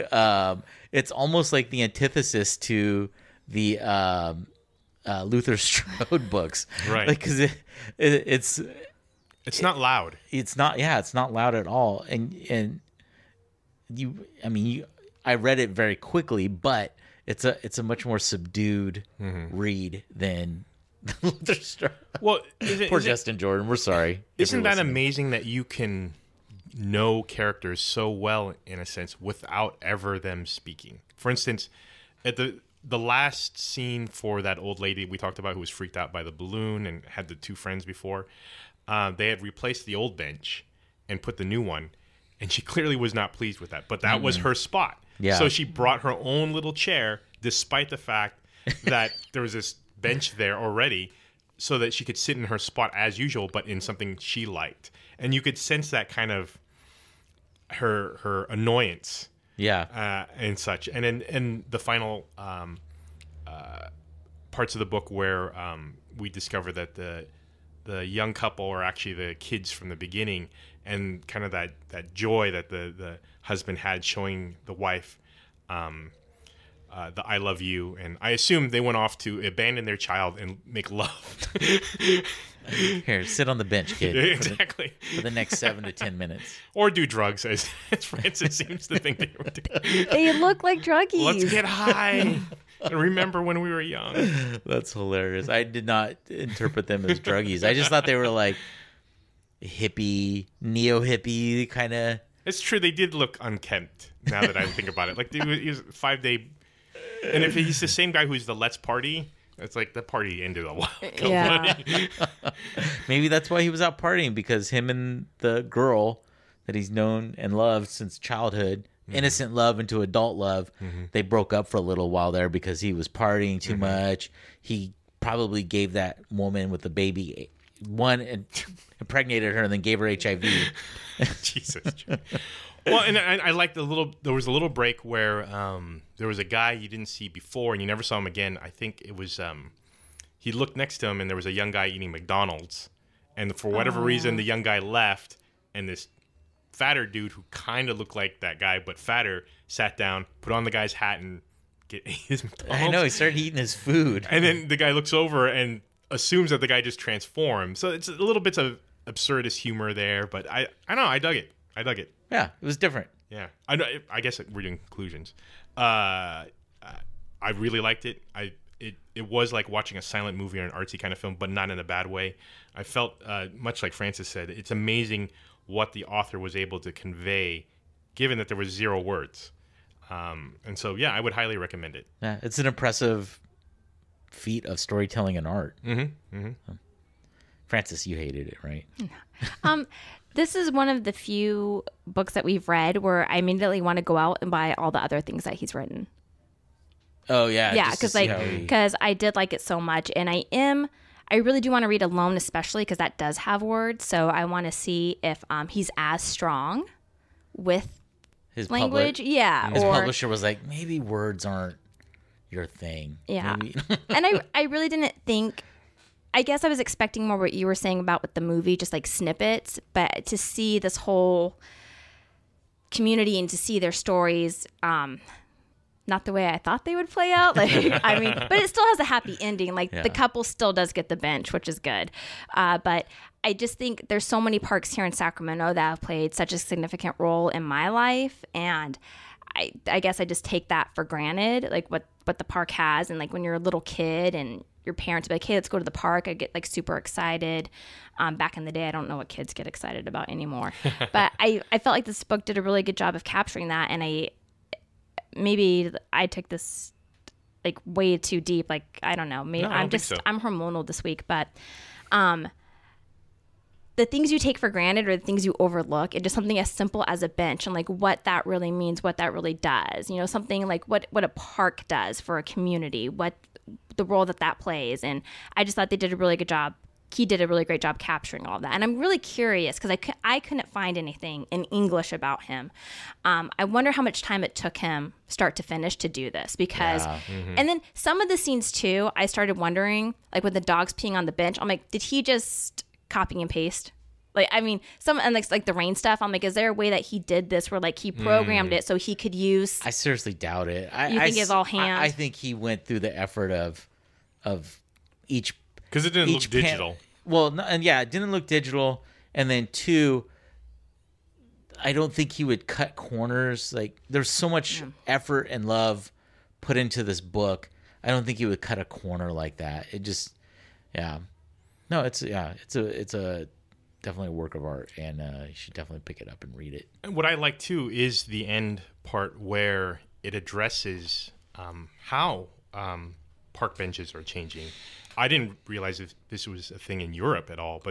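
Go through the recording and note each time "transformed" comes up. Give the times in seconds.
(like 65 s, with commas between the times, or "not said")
157 s.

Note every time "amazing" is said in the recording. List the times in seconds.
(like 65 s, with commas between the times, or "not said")
24 s, 174 s.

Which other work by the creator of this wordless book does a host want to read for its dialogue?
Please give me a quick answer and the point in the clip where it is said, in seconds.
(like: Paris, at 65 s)
Alone, at 202 s.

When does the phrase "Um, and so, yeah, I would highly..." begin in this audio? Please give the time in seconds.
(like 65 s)
180 s.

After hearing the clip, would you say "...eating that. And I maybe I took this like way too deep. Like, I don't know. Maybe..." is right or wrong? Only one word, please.
wrong.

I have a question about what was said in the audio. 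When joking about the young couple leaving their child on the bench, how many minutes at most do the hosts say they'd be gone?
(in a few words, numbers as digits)
10.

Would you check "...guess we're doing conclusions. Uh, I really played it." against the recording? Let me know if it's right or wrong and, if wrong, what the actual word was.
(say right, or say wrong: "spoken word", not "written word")
wrong: "liked", not "played".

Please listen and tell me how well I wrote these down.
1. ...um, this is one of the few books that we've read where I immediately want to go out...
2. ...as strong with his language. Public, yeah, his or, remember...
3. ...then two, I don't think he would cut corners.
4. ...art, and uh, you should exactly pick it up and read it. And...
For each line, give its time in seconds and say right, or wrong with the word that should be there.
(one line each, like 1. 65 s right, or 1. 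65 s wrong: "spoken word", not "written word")
1. 189 s right
2. 205 s wrong: "publisher", not "remember"
3. 309 s right
4. 324 s wrong: "definitely", not "exactly".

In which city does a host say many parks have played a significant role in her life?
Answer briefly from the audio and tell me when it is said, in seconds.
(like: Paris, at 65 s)
Sacramento, at 235 s.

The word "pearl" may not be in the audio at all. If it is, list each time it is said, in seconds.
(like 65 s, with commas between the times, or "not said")
not said.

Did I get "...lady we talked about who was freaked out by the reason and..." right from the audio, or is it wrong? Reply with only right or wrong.
wrong.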